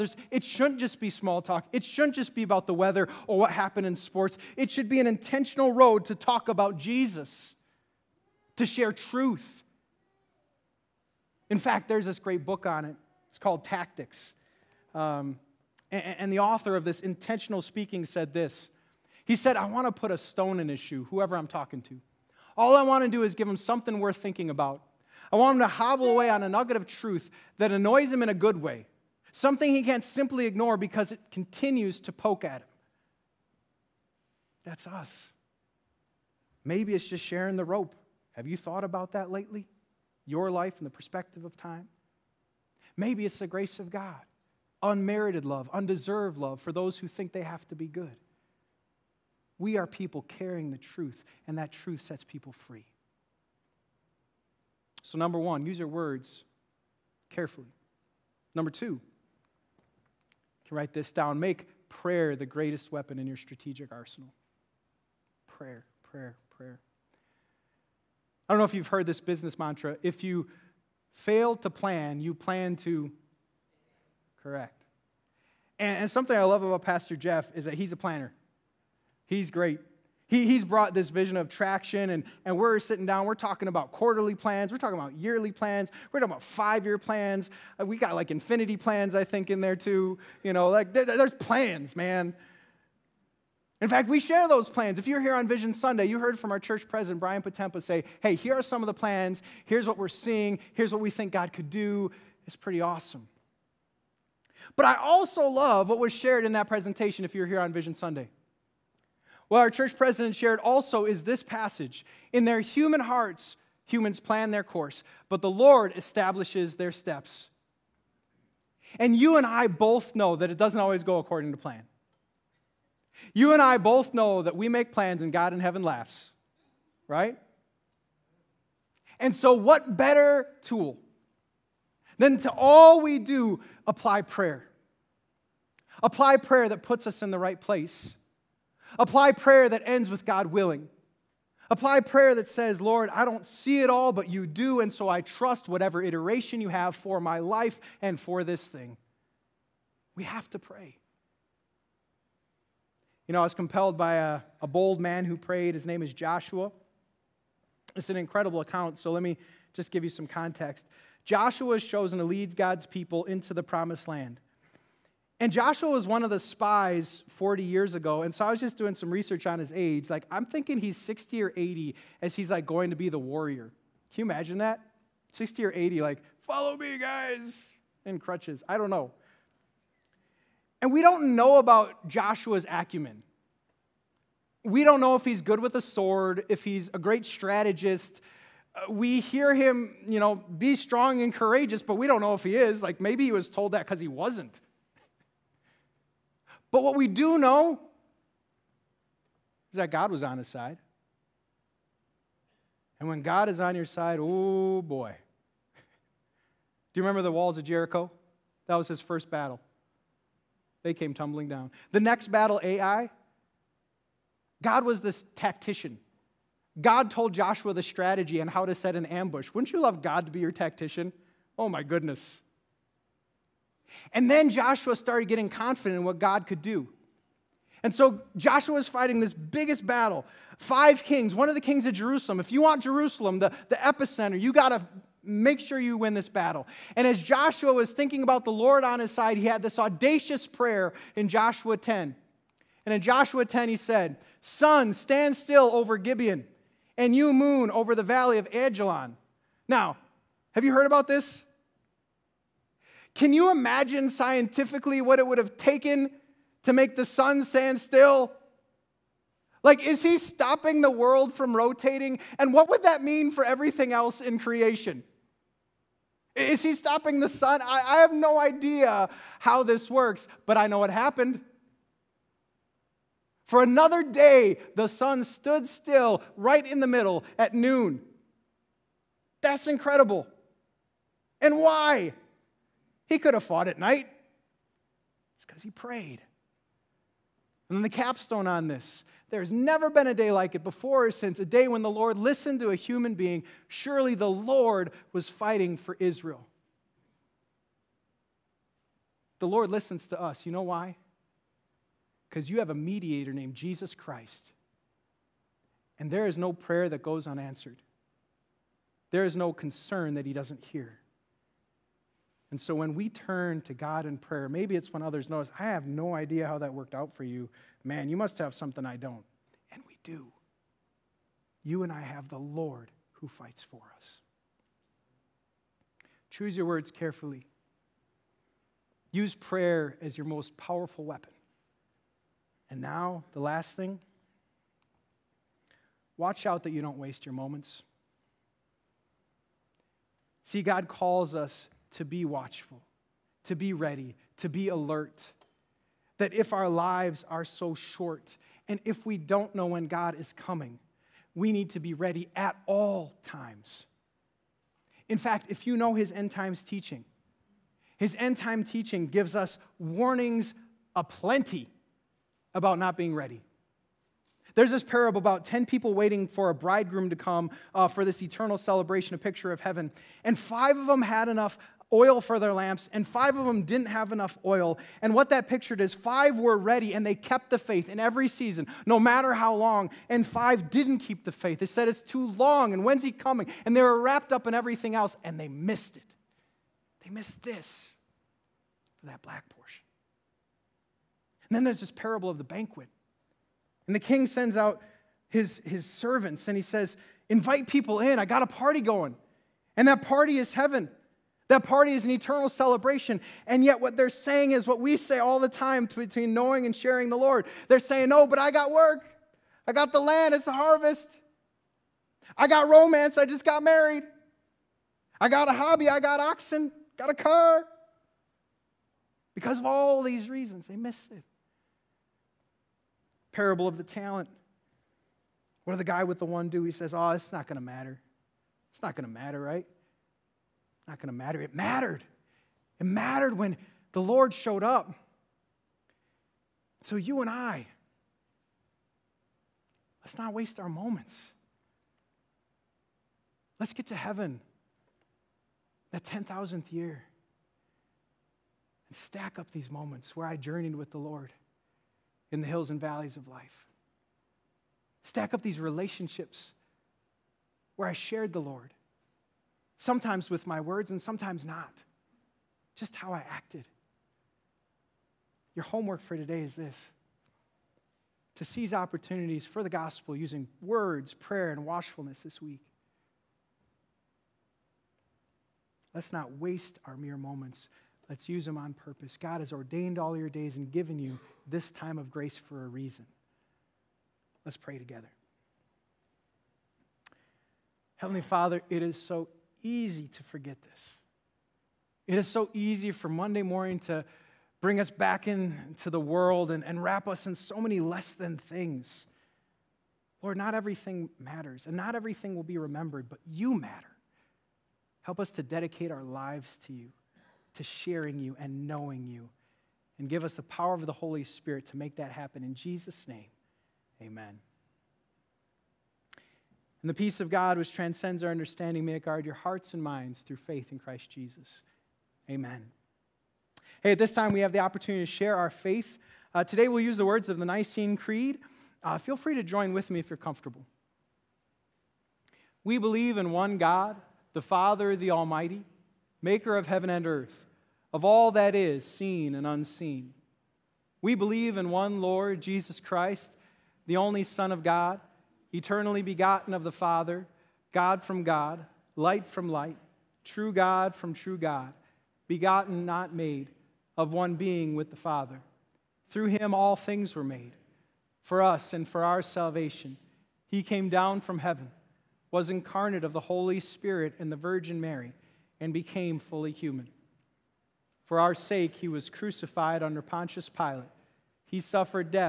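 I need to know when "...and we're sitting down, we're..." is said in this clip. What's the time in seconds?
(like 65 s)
82 s.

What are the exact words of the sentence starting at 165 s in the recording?
And Joshua was one of the spies 40 years ago.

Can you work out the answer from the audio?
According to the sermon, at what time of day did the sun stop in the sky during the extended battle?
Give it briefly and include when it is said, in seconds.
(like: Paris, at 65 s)
Noon, at 277 s.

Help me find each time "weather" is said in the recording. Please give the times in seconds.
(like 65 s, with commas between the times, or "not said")
2 s.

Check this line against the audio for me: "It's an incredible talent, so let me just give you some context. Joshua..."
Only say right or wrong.
wrong.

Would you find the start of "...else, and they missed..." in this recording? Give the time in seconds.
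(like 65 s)
384 s.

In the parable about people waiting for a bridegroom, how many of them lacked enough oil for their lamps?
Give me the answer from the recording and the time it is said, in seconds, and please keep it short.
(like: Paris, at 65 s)
5, at 373 s.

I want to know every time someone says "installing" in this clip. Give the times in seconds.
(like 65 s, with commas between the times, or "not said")
not said.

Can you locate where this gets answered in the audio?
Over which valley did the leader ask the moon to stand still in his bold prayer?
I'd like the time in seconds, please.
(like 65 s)
247 s.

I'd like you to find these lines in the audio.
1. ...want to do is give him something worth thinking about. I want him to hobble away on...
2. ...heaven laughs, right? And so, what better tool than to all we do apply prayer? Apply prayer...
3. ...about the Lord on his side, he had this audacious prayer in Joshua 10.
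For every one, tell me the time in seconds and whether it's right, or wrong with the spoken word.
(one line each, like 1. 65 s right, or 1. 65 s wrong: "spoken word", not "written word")
1. 22 s right
2. 125 s right
3. 238 s right.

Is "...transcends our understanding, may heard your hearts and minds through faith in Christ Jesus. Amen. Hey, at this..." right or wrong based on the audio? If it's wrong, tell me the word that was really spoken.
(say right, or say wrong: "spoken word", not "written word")
wrong: "guard", not "heard".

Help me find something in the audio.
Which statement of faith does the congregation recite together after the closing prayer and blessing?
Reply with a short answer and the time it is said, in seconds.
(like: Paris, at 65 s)
Nicene Creed, at 527 s.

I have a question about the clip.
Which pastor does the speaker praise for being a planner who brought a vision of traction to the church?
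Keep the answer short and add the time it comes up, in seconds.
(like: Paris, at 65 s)
Pastor Jeff, at 76 s.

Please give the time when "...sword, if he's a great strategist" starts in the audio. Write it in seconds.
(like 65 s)
185 s.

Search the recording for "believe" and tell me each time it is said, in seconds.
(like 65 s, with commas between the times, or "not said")
532 s, 541 s.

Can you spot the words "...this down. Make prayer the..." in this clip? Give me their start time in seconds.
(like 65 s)
60 s.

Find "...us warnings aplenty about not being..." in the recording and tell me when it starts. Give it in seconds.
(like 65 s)
359 s.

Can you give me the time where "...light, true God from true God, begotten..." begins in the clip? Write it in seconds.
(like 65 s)
549 s.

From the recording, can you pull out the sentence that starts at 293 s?
Surely the Lord was fighting for Israel.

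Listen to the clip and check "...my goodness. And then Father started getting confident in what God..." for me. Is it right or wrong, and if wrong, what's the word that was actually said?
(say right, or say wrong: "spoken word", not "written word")
wrong: "Joshua", not "Father".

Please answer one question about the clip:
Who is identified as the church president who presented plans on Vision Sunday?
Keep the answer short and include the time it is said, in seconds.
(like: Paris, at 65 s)
Brian Potempa, at 97 s.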